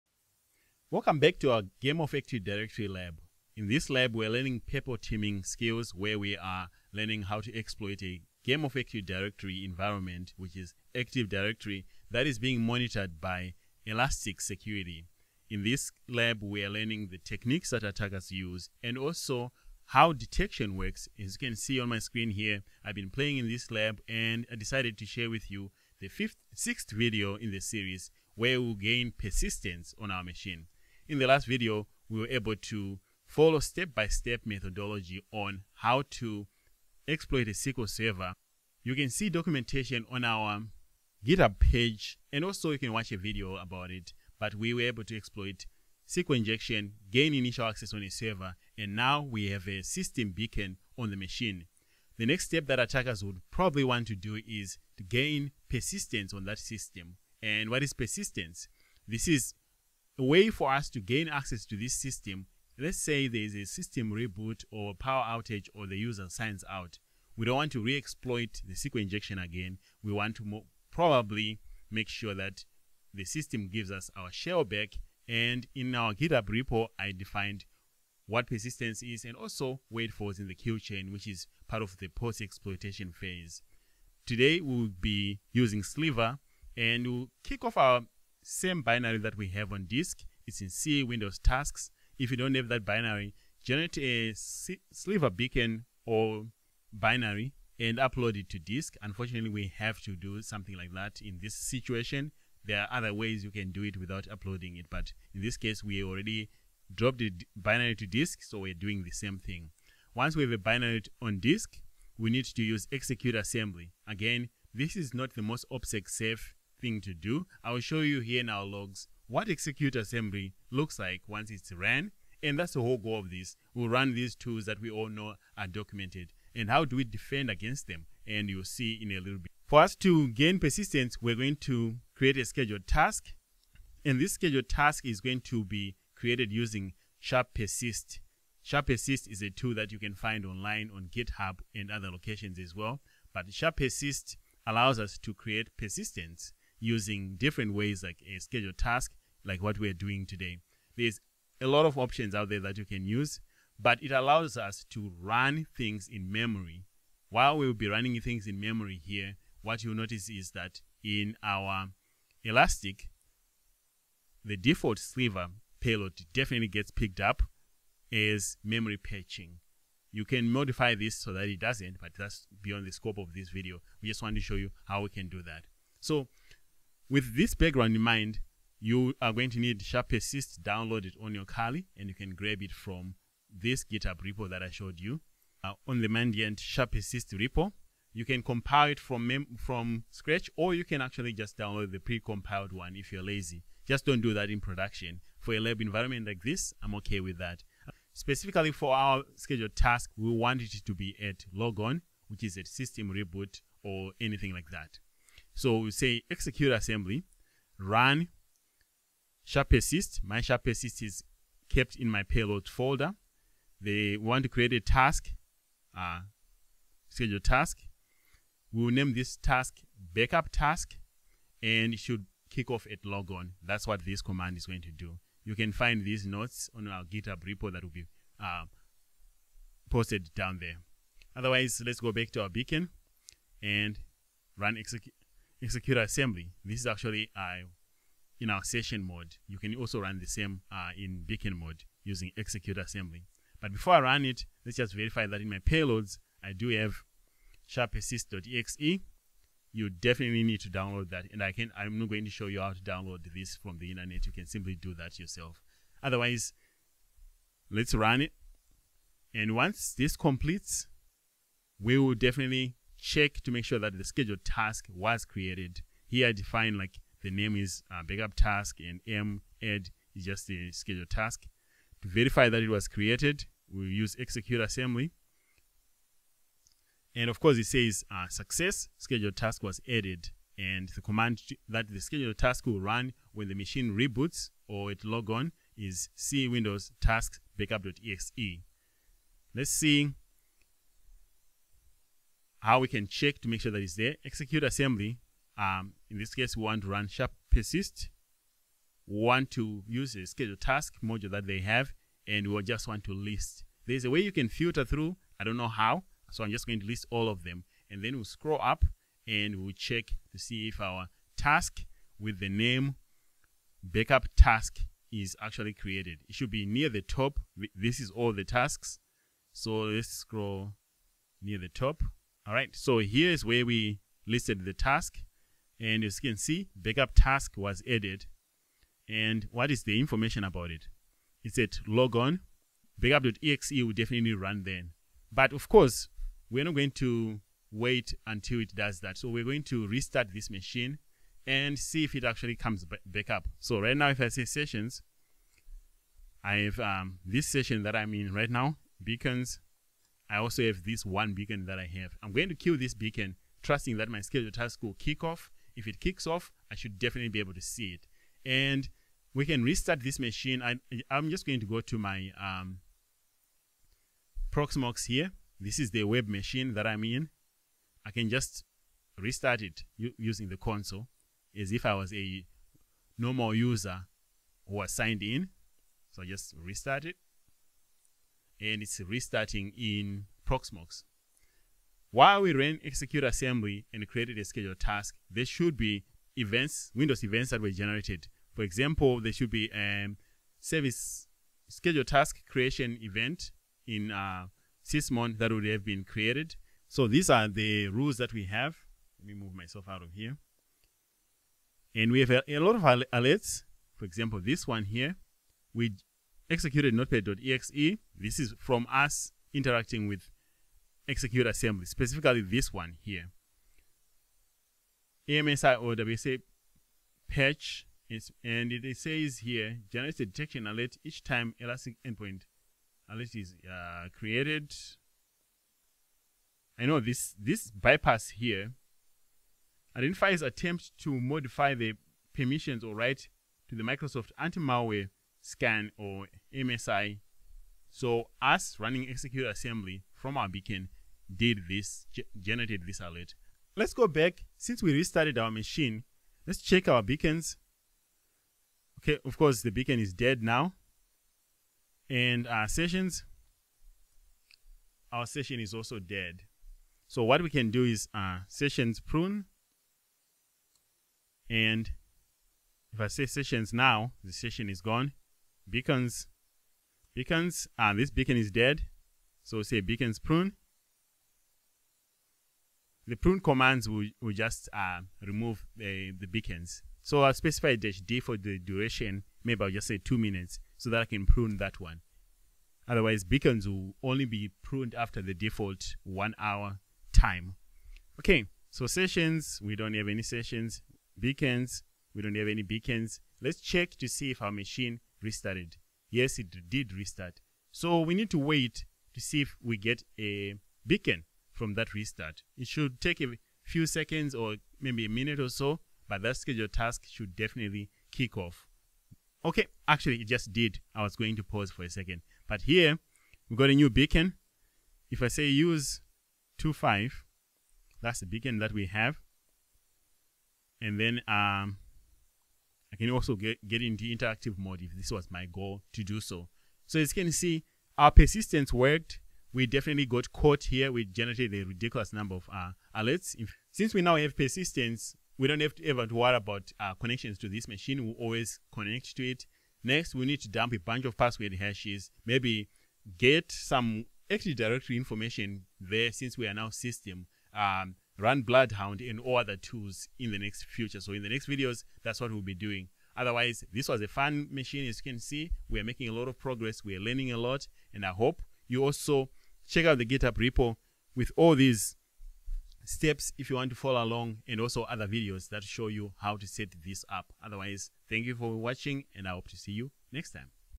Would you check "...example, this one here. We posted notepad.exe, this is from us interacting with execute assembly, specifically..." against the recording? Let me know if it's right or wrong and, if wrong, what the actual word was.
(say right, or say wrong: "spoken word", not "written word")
wrong: "executed", not "posted".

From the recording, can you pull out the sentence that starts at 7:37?
So what we can do is uh, sessions prune.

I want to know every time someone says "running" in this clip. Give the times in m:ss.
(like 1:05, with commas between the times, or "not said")
2:37, 7:18.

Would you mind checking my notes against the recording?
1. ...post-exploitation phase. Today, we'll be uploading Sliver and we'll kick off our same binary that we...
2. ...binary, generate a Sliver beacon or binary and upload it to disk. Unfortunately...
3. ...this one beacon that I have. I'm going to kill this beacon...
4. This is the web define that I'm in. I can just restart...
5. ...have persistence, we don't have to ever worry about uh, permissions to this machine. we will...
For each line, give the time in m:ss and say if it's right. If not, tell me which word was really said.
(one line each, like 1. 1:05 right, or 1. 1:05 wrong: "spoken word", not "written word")
1. 1:22 wrong: "using", not "uploading"
2. 1:32 right
3. 5:50 right
4. 6:05 wrong: "machine", not "define"
5. 8:54 wrong: "connections", not "permissions".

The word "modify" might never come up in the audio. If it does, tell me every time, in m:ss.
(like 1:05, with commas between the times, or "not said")
2:50, 7:11.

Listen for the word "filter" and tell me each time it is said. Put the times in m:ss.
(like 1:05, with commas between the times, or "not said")
5:04.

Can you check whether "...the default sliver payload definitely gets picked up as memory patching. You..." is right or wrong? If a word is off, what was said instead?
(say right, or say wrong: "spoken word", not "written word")
right.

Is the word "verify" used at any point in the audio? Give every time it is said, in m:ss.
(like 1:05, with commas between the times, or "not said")
4:04, 4:32.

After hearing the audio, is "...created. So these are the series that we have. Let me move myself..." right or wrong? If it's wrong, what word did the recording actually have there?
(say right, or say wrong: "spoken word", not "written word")
wrong: "rules", not "series".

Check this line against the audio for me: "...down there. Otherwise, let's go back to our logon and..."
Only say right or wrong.
wrong.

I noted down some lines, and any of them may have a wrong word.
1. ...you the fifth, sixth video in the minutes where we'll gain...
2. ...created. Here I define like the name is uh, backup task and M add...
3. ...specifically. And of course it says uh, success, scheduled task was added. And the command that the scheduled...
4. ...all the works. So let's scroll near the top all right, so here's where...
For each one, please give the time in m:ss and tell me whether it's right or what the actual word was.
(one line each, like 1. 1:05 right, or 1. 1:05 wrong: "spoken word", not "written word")
1. 0:25 wrong: "series", not "minutes"
2. 4:25 right
3. 4:34 wrong: "assembly", not "specifically"
4. 5:18 wrong: "tasks", not "works".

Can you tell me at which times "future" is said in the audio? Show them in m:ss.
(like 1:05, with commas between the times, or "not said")
9:10.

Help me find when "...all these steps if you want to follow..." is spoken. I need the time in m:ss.
9:21.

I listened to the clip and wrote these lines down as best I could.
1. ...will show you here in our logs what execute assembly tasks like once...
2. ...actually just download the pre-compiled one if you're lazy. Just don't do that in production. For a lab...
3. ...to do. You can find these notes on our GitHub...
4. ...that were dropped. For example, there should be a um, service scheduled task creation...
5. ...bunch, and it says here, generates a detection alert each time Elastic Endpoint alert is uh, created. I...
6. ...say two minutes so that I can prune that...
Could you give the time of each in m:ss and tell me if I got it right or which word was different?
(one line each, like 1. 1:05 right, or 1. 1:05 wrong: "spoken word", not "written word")
1. 1:57 wrong: "looks", not "tasks"
2. 3:11 right
3. 3:44 right
4. 6:27 wrong: "generated", not "dropped"
5. 6:57 wrong: "patch", not "bunch"
6. 7:59 right.